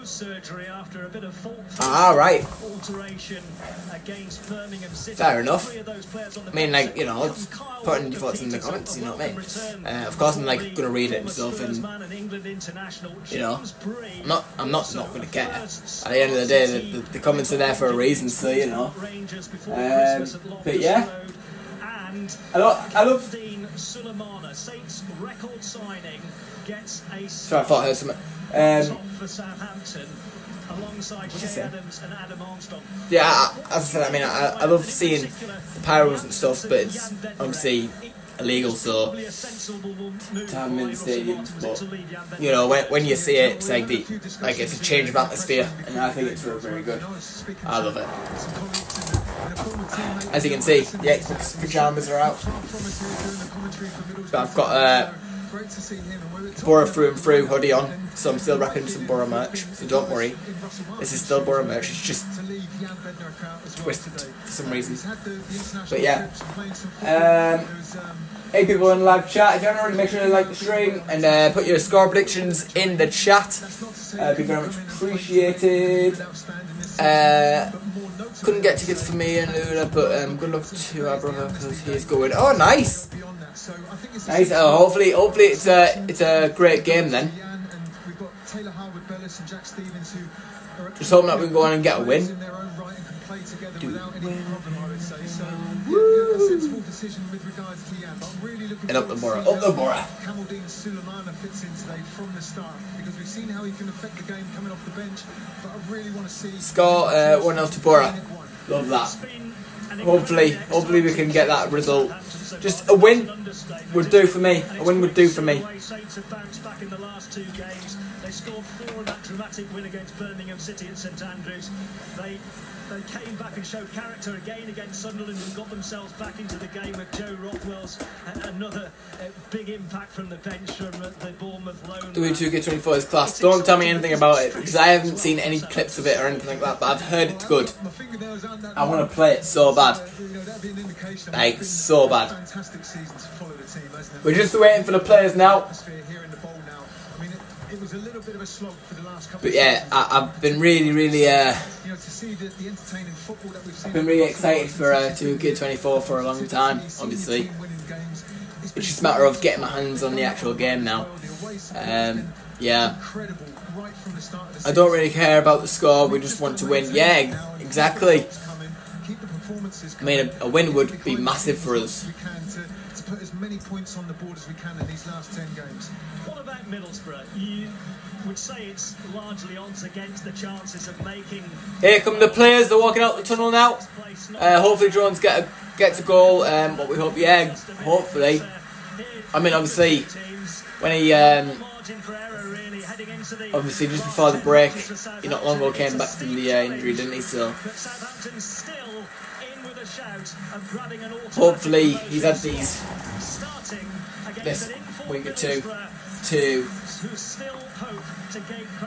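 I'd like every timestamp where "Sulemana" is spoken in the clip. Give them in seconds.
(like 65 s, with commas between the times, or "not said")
23 s, 100 s.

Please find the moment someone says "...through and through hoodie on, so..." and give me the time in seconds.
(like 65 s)
56 s.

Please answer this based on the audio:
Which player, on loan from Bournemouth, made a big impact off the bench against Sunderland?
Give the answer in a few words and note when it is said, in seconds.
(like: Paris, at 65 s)
Joe Rothwell, at 127 s.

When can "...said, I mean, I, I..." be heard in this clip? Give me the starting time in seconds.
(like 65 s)
33 s.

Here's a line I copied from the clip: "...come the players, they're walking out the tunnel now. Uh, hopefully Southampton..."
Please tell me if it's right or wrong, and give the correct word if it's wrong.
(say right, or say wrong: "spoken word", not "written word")
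wrong: "Drones", not "Southampton".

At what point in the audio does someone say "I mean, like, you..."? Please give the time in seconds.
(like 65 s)
6 s.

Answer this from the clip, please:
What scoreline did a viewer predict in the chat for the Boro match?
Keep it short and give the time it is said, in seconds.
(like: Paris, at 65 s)
1-0 to Boro, at 107 s.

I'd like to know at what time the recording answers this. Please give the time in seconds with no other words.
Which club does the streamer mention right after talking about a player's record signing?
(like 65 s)
29 s.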